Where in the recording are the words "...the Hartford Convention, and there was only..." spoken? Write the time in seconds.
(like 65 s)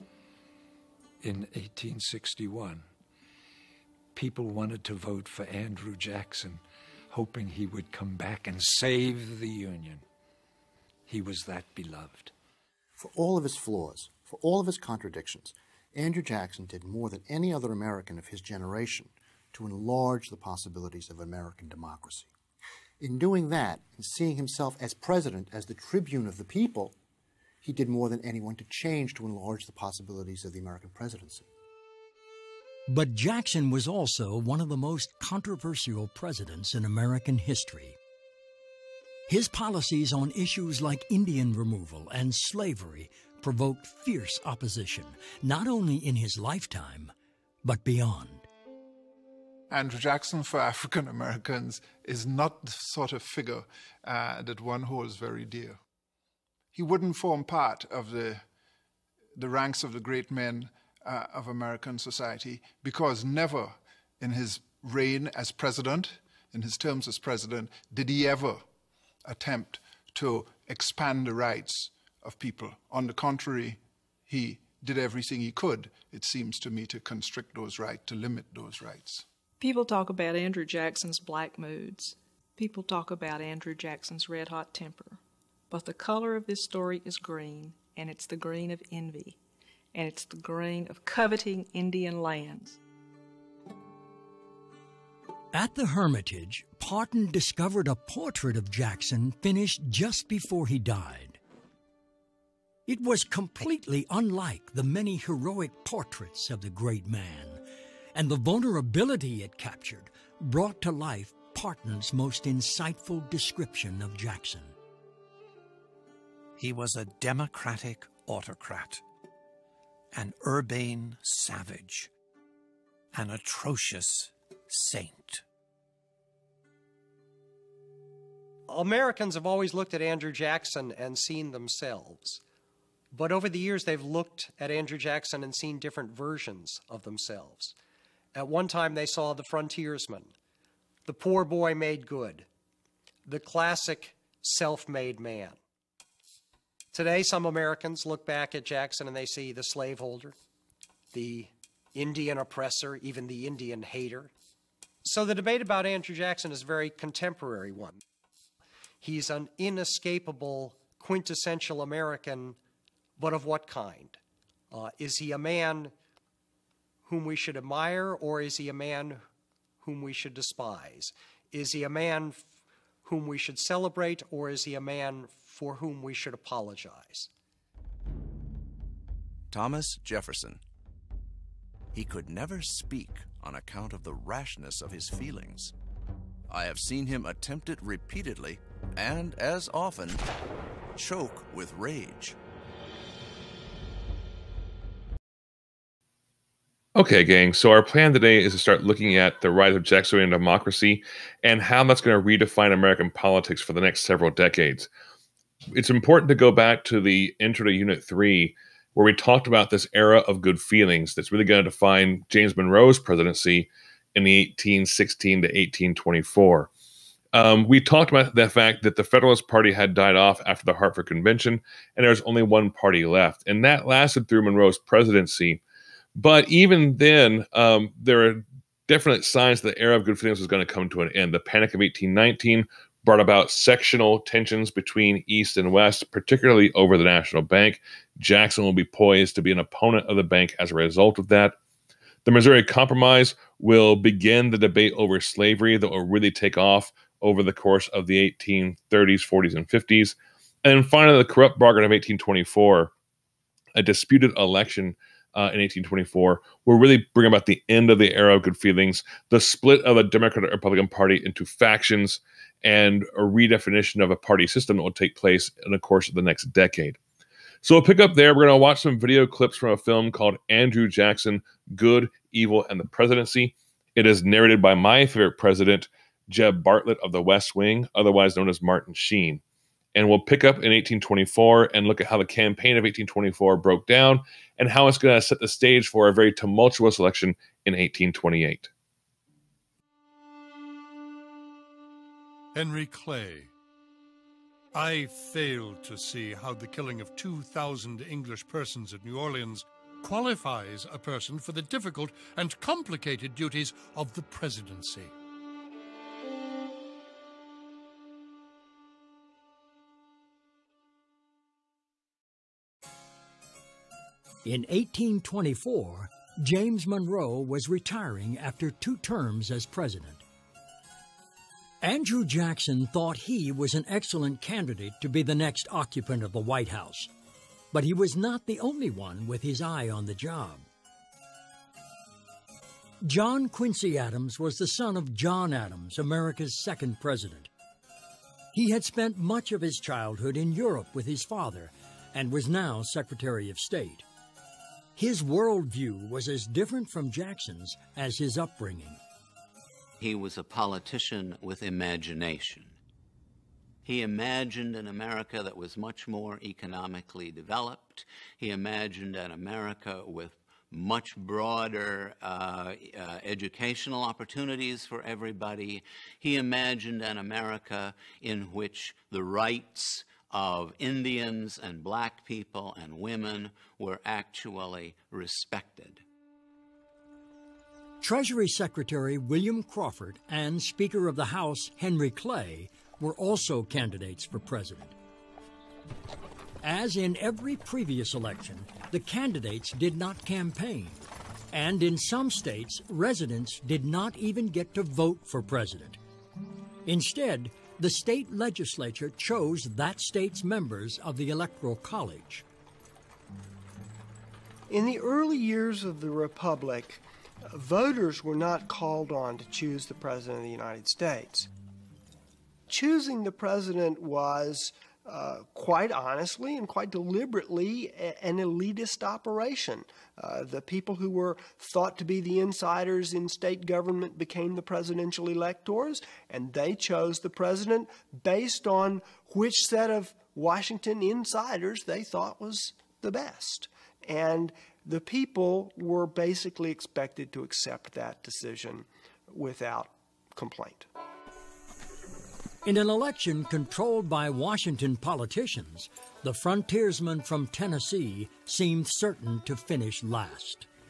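220 s.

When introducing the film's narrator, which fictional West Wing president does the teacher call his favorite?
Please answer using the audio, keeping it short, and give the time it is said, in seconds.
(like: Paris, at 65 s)
Jeb Bartlet, at 276 s.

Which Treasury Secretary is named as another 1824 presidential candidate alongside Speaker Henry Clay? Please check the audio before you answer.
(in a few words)
William Crawford.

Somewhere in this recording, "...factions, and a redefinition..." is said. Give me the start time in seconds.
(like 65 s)
261 s.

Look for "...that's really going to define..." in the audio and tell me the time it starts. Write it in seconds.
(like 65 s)
211 s.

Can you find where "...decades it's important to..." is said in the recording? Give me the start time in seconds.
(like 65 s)
204 s.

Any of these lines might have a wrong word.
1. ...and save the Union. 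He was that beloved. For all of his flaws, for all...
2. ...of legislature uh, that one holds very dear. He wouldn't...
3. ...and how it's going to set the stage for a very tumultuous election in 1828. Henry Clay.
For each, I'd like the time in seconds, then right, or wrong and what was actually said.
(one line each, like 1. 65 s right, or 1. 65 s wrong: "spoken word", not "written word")
1. 8 s right
2. 53 s wrong: "figure", not "legislature"
3. 284 s right.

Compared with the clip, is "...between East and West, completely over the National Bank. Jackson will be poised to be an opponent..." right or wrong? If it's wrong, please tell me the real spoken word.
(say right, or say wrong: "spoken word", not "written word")
wrong: "particularly", not "completely".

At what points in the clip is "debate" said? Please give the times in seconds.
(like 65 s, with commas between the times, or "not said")
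155 s, 244 s.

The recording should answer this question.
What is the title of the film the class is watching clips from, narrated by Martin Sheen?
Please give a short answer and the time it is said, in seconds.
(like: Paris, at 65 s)
Andrew Jackson Good, Evil, and the Presidency, at 270 s.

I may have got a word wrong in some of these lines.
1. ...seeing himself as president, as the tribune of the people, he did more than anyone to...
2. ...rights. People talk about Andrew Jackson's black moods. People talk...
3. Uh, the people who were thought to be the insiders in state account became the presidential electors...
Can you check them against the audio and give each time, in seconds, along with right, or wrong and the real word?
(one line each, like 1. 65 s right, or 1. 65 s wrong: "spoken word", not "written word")
1. 24 s right
2. 78 s right
3. 420 s wrong: "government", not "account".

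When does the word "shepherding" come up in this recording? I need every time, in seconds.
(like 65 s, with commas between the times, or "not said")
not said.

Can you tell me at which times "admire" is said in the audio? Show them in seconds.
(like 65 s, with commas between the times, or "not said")
167 s.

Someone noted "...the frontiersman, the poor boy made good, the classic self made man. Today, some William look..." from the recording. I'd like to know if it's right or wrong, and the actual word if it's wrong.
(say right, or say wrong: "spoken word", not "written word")
wrong: "Americans", not "William".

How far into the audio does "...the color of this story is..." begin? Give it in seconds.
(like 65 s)
85 s.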